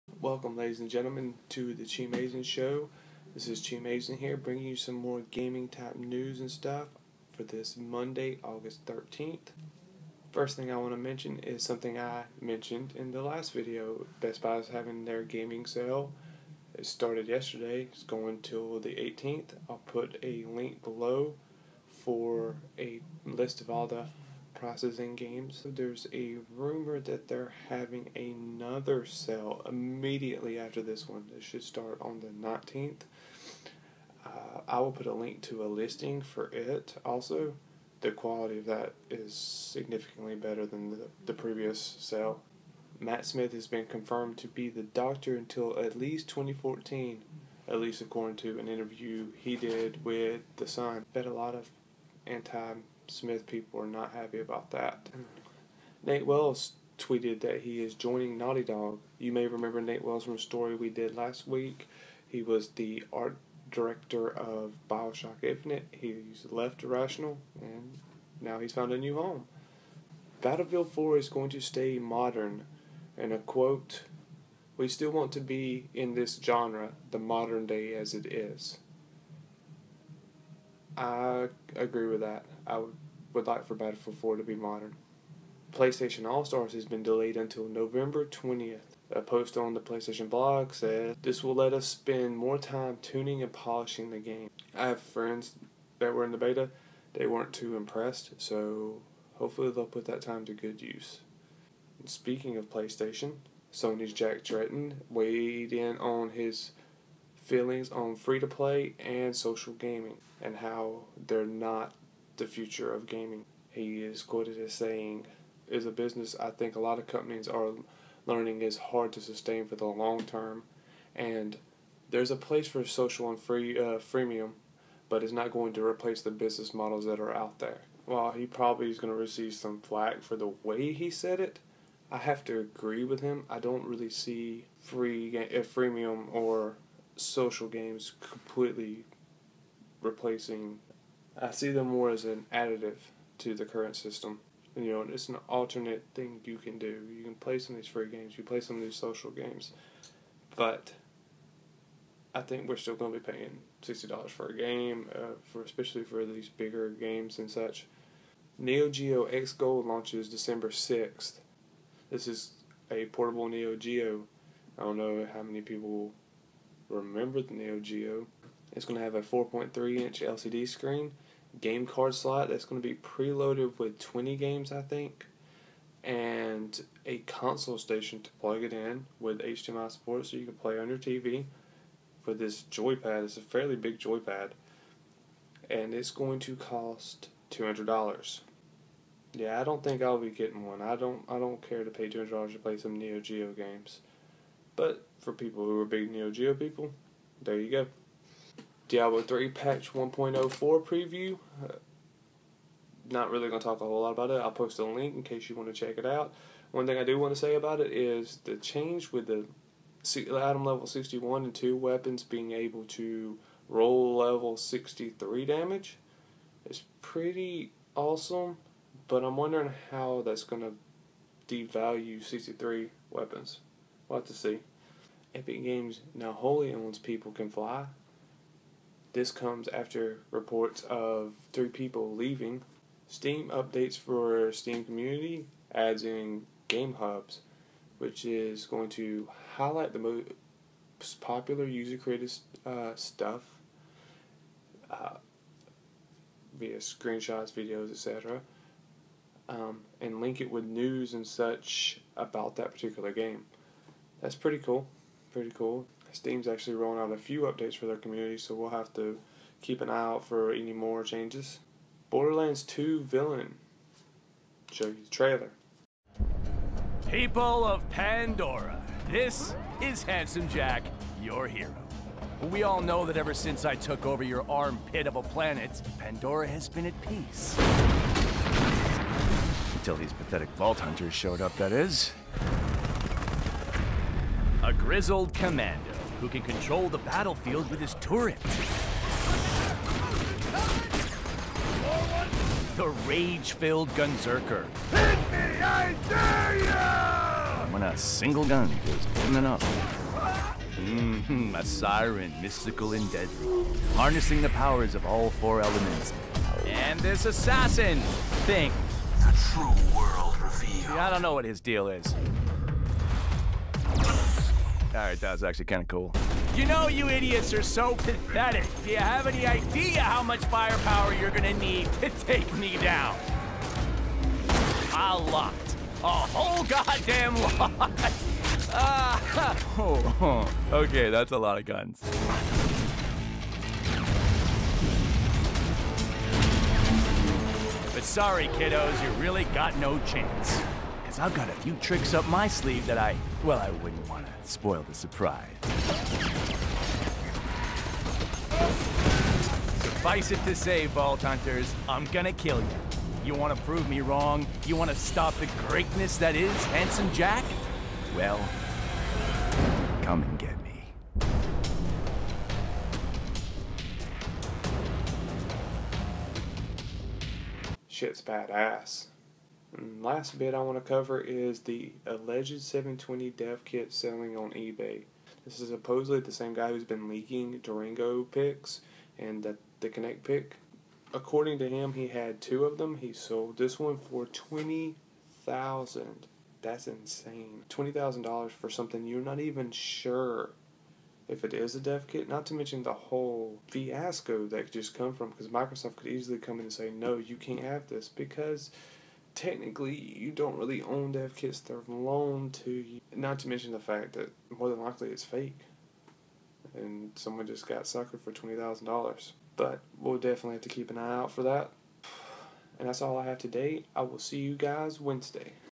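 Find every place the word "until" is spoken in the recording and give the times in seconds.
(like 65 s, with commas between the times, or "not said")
45 s, 87 s, 279 s.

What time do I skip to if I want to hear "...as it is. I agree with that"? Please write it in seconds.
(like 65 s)
77 s.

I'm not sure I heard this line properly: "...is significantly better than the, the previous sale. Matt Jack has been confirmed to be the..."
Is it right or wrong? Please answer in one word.
wrong.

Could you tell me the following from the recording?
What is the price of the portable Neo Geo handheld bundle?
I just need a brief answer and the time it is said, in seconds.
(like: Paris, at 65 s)
$200, at 187 s.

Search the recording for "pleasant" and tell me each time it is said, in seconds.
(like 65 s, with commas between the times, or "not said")
not said.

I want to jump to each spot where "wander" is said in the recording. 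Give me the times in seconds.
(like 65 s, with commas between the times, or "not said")
not said.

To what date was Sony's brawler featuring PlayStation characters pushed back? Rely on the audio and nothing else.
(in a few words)
November 20th.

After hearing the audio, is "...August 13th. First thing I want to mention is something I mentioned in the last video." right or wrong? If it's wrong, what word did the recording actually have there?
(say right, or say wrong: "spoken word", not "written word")
right.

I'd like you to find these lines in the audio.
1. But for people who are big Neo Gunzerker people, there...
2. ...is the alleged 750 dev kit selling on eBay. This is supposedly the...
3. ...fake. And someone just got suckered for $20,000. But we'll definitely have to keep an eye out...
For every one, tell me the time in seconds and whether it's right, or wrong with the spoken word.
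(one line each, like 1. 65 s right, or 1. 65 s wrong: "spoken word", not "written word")
1. 194 s wrong: "Geo", not "Gunzerker"
2. 371 s wrong: "720", not "750"
3. 405 s right.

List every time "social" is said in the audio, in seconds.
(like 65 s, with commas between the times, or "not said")
109 s, 122 s, 137 s, 148 s.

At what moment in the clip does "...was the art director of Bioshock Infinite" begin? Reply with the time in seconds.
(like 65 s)
62 s.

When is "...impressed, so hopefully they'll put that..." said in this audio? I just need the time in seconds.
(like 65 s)
97 s.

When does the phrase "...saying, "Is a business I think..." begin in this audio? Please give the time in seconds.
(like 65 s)
114 s.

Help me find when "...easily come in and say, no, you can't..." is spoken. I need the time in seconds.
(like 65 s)
396 s.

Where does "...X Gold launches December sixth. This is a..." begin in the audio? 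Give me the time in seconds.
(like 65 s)
159 s.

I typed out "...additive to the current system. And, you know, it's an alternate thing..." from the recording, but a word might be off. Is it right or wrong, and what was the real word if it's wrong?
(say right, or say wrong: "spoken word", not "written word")
right.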